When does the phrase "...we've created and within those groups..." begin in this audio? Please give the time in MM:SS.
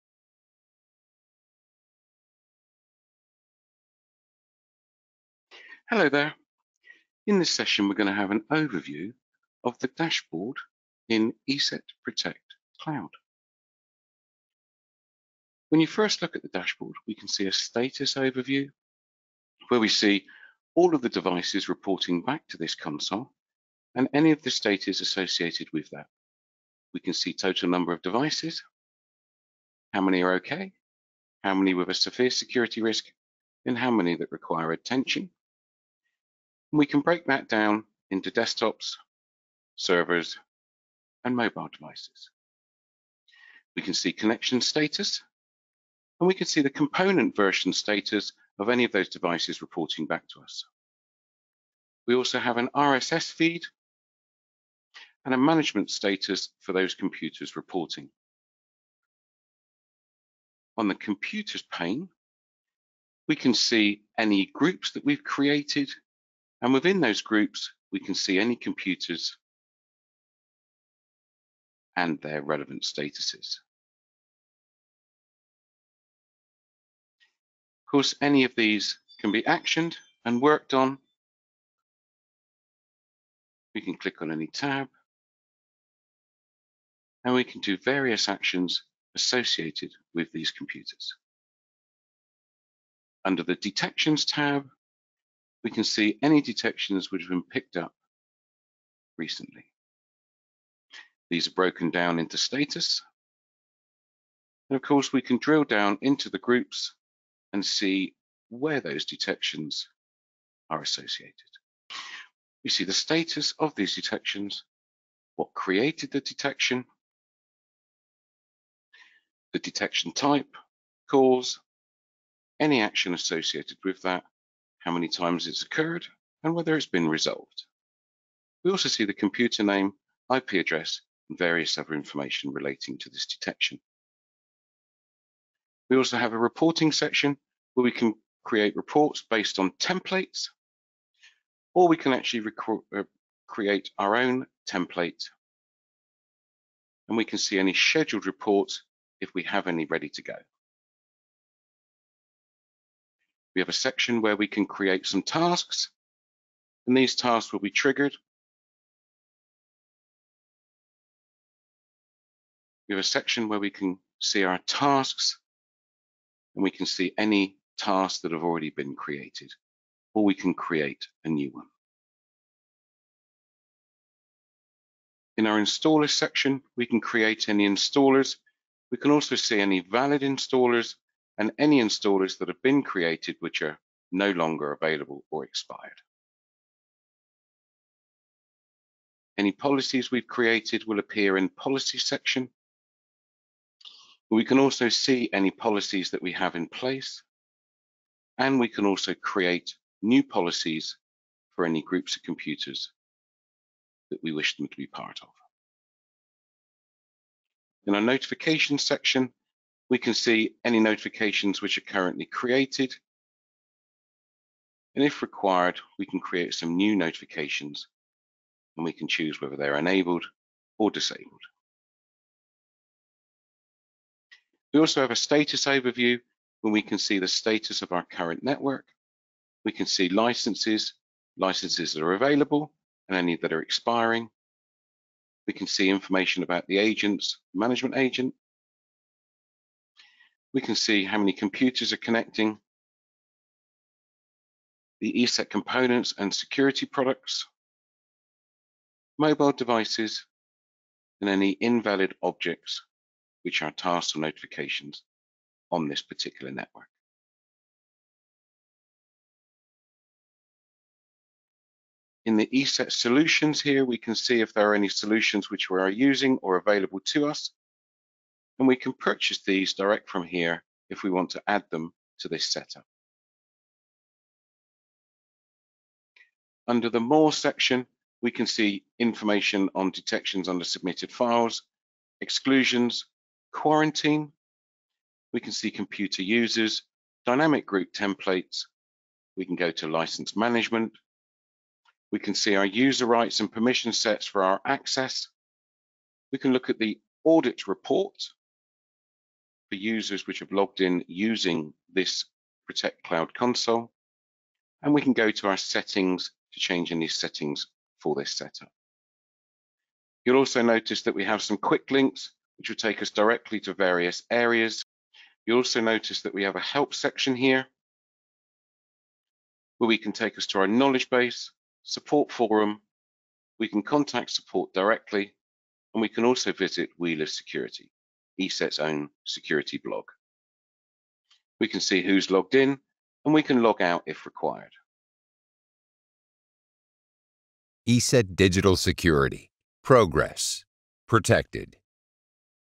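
01:05.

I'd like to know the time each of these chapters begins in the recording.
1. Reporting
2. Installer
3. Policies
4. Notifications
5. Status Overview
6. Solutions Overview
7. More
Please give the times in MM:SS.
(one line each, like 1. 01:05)
1. 02:15
2. 02:54
3. 03:09
4. 03:27
5. 03:44
6. 04:20
7. 04:35.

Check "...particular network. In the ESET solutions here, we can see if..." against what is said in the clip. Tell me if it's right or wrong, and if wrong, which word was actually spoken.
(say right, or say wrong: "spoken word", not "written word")
right.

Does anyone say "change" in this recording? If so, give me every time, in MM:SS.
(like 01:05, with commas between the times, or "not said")
05:06.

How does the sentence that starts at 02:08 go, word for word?
We also see the computer name, IP address, and various other information relating to this detection.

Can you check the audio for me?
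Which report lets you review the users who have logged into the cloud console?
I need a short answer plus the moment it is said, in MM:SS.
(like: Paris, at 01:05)
audit report, at 04:57.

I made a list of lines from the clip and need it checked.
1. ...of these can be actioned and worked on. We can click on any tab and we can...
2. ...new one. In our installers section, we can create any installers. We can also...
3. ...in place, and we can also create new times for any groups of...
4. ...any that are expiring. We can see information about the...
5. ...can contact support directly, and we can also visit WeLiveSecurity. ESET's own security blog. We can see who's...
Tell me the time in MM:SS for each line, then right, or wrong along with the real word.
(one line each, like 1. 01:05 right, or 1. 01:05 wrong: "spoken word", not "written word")
1. 01:18 right
2. 02:51 right
3. 03:16 wrong: "policies", not "times"
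4. 03:53 right
5. 05:23 right.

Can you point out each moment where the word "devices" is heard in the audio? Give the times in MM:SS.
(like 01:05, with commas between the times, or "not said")
00:21, 00:28, 00:41, 00:49, 04:09.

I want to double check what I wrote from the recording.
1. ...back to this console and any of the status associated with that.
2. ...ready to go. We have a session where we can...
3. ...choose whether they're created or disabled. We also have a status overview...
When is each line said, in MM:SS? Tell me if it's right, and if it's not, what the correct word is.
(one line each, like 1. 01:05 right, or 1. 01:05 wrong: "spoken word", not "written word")
1. 00:22 right
2. 02:29 wrong: "section", not "session"
3. 03:39 wrong: "enabled", not "created".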